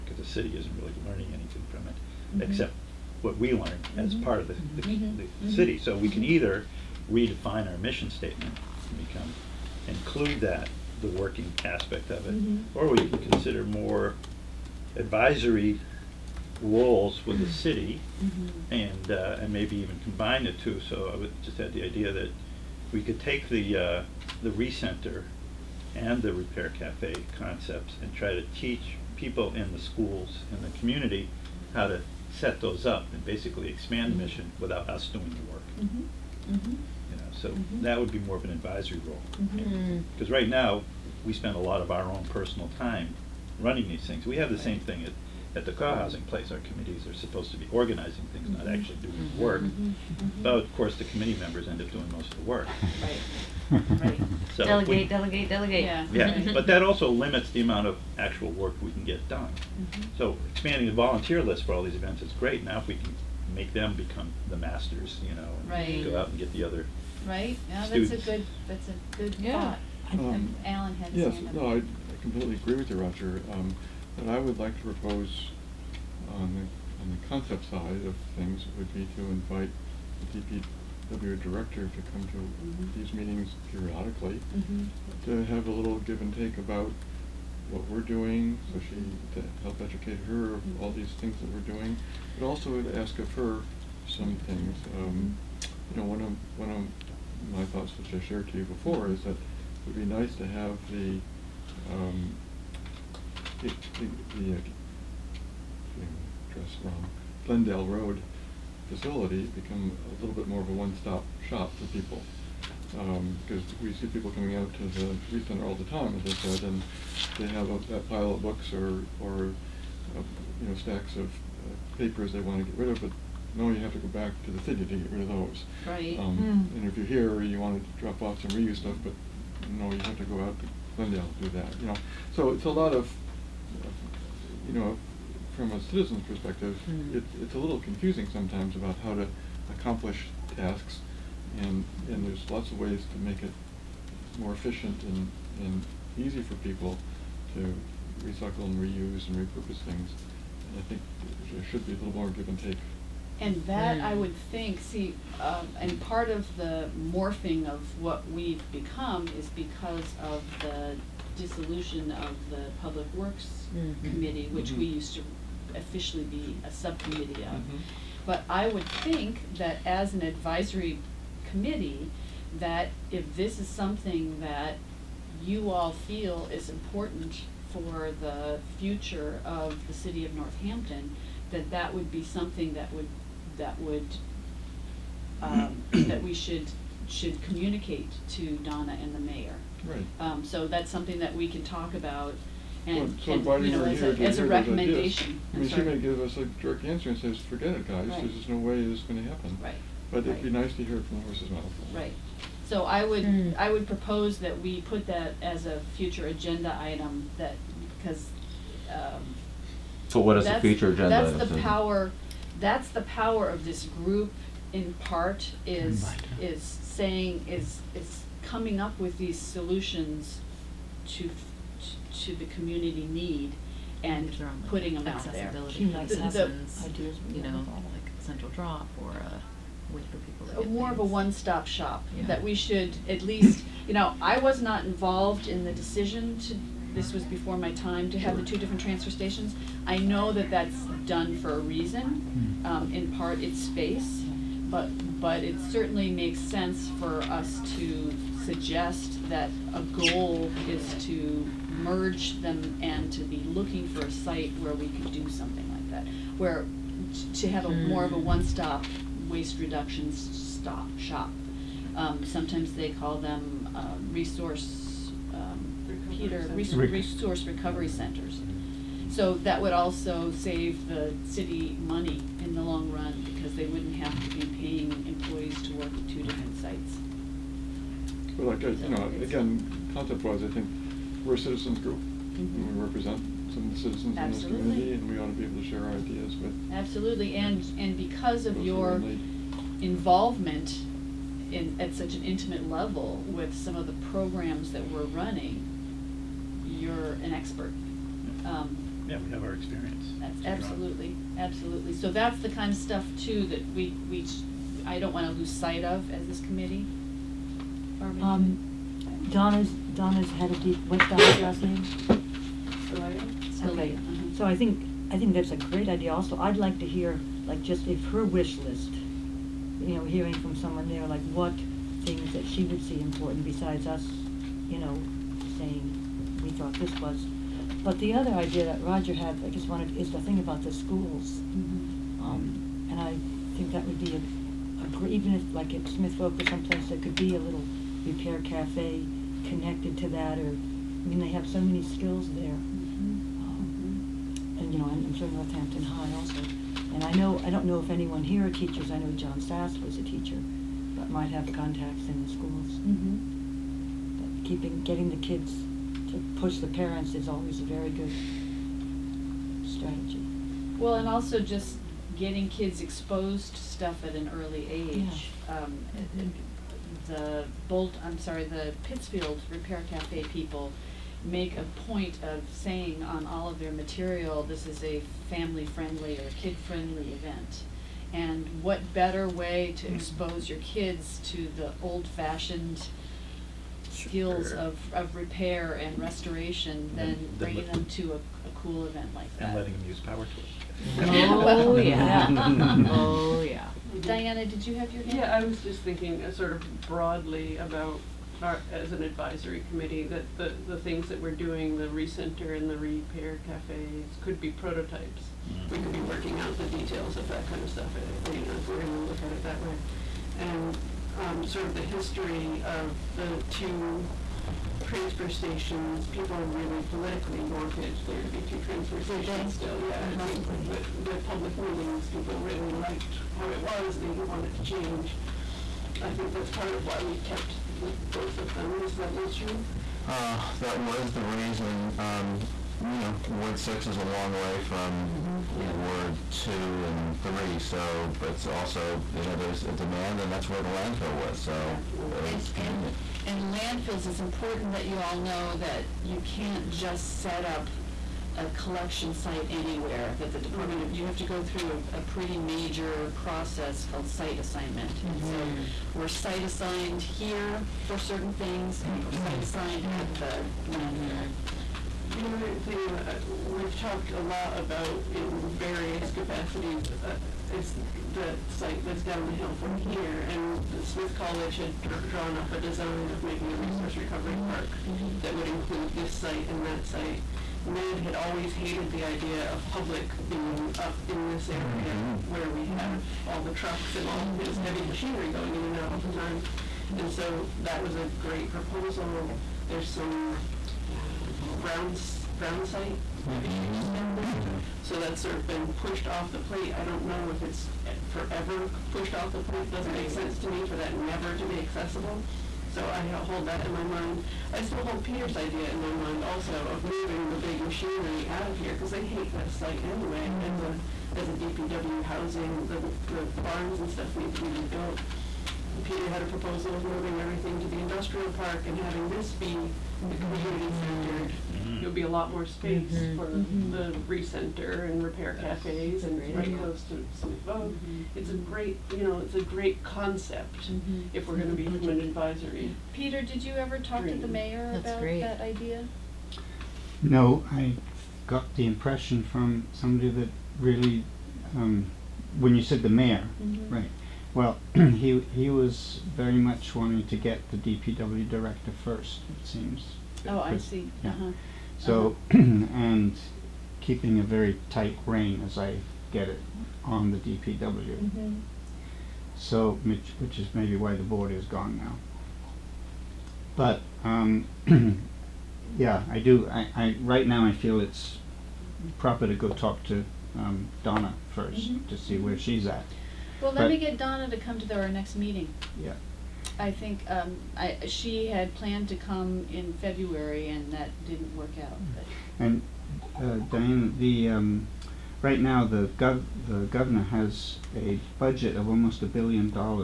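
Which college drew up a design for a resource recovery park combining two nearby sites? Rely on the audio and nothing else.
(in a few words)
Smith College.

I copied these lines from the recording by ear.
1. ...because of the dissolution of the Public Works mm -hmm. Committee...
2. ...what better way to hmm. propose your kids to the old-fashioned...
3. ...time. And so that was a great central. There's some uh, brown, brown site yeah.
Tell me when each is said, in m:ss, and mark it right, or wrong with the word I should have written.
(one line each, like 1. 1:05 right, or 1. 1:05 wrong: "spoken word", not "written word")
1. 2:39 right
2. 6:18 wrong: "expose", not "propose"
3. 8:06 wrong: "proposal", not "central".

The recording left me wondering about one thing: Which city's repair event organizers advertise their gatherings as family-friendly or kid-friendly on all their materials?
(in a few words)
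Pittsfield.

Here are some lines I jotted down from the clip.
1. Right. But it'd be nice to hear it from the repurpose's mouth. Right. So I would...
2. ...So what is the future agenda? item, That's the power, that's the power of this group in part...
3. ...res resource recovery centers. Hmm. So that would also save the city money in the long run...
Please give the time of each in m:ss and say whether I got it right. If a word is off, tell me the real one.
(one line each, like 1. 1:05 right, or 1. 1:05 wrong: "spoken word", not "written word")
1. 3:19 wrong: "horse", not "repurpose"
2. 3:30 right
3. 4:26 right.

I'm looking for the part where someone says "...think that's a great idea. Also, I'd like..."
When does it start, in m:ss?
5:15.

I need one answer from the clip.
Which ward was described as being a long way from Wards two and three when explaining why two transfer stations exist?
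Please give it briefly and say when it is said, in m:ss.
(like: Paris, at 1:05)
Ward 6, at 7:13.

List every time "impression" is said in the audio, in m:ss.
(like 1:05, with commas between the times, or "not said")
8:58.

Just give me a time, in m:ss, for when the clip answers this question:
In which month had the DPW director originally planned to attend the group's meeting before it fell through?
9:39.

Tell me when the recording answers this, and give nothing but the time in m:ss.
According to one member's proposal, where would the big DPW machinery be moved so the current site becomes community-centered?
8:37.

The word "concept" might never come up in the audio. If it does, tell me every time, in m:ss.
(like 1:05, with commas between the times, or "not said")
0:27, 1:17, 4:39, 8:49.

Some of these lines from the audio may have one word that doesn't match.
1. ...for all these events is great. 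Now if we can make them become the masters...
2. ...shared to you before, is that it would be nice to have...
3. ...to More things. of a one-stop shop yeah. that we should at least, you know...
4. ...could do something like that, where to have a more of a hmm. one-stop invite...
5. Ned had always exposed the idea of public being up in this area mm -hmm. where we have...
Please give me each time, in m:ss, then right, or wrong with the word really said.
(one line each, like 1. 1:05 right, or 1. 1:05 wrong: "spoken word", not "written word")
1. 1:01 right
2. 1:38 right
3. 3:50 right
4. 4:14 wrong: "waste", not "invite"
5. 7:57 wrong: "hated", not "exposed".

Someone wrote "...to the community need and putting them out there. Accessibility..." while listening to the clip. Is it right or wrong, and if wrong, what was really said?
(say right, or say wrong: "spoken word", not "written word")
right.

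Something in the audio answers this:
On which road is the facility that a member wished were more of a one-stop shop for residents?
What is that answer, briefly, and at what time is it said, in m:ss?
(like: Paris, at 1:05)
Glendale Road, at 1:47.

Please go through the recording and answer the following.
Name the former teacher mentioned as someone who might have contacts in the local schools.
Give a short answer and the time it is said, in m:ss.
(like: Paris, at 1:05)
John Sass, at 5:49.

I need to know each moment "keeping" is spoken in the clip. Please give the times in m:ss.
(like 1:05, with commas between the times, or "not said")
5:54, 9:13.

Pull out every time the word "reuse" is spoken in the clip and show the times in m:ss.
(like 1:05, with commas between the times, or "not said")
2:08, 2:28.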